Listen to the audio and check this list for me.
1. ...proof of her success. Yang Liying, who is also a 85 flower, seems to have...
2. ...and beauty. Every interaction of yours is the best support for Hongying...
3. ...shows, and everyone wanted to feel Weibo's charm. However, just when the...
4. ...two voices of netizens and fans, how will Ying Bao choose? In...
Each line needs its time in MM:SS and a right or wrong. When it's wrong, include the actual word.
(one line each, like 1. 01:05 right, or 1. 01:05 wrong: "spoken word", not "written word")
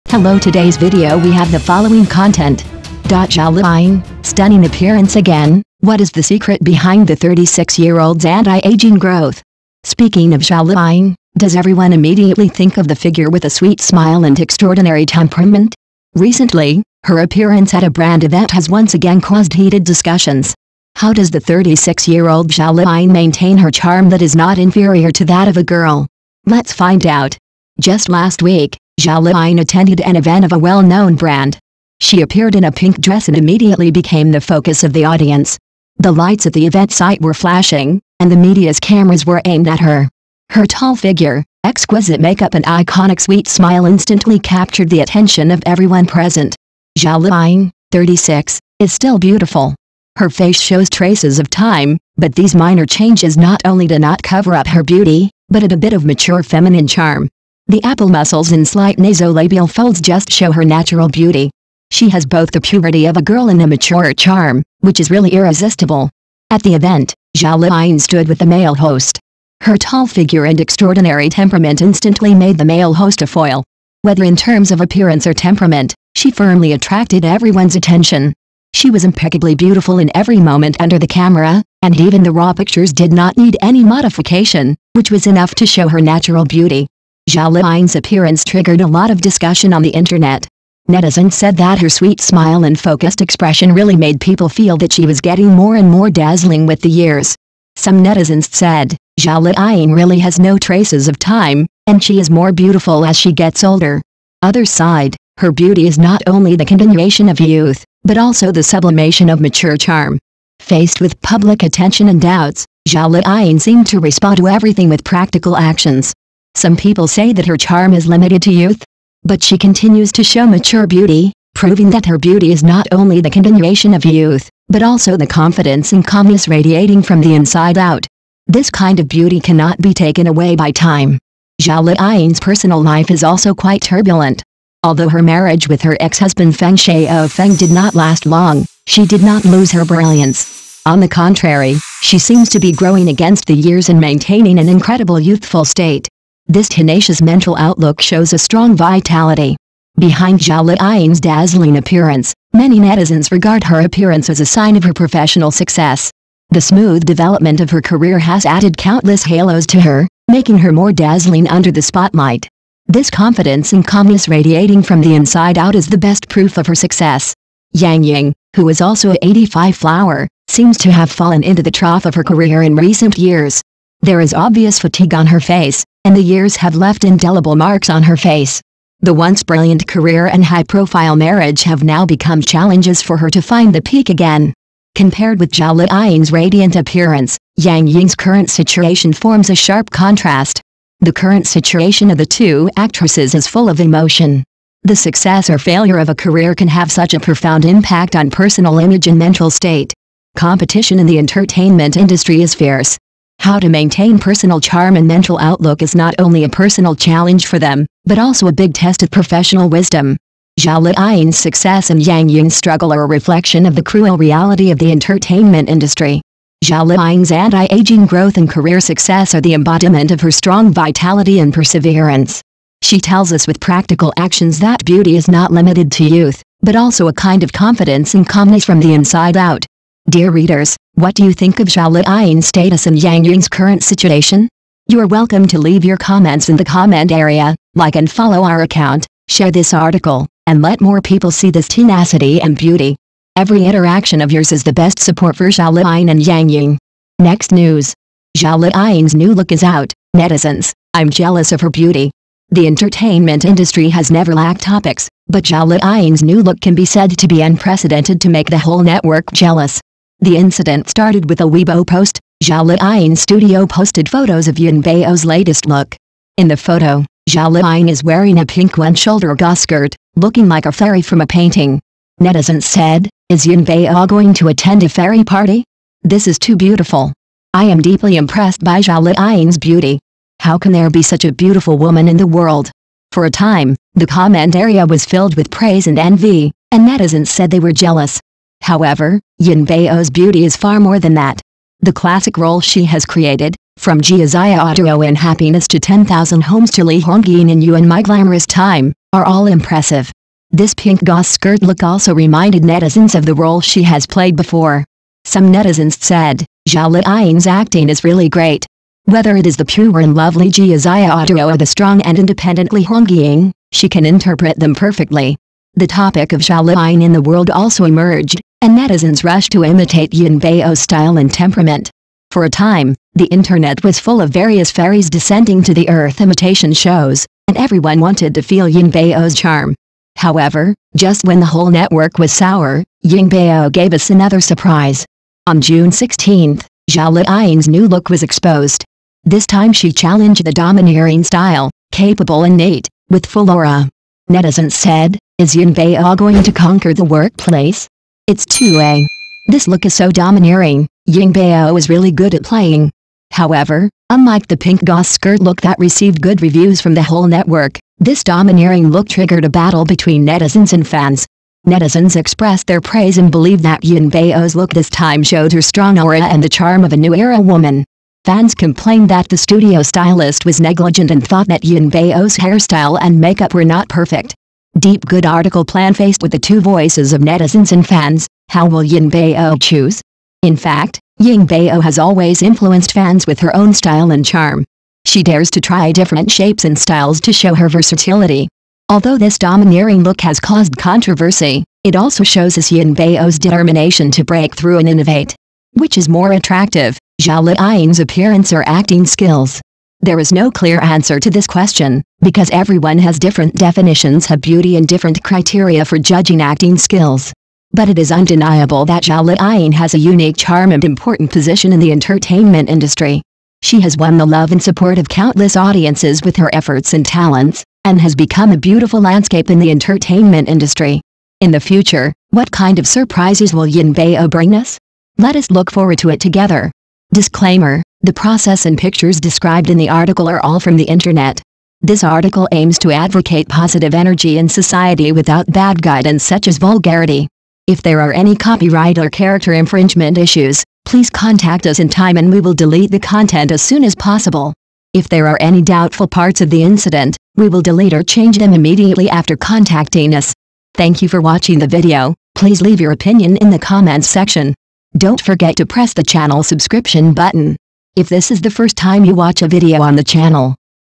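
1. 02:46 wrong: "Ying", not "Liying"
2. 04:02 wrong: "Zhao", not "Hongying"
3. 05:26 wrong: "Bao", not "Weibo"
4. 06:16 right.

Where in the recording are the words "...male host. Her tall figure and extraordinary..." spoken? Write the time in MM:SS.
01:08.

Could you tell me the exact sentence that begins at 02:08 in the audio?
This kind of beauty cannot be taken away by time.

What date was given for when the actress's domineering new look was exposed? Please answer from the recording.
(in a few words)
June 16.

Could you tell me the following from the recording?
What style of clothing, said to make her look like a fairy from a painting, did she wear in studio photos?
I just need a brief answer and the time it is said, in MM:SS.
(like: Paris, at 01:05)
one-shoulder skirt, at 04:28.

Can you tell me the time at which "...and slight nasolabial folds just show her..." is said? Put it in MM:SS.
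00:58.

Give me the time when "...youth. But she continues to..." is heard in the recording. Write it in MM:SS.
01:58.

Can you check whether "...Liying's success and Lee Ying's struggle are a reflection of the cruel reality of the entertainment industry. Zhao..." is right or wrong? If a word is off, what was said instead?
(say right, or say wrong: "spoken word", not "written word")
wrong: "Yang", not "Lee".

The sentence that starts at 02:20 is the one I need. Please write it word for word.
On the contrary, she seems to be growing against the years and maintaining an incredible youthful state.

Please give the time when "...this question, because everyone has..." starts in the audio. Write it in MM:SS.
06:41.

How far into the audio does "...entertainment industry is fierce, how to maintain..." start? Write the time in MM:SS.
03:21.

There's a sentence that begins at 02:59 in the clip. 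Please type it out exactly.
The once brilliant career and high-profile marriage have now become challenges for her to find the peak again.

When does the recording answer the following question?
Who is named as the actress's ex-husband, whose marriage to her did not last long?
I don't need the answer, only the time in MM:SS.
02:16.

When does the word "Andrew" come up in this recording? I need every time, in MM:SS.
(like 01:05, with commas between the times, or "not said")
not said.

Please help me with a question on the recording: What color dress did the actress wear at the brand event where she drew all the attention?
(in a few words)
pink dress.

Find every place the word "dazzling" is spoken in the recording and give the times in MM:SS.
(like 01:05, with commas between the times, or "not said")
01:36, 02:31, 02:40.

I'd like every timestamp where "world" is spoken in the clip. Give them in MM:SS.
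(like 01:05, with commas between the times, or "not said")
04:42, 05:17.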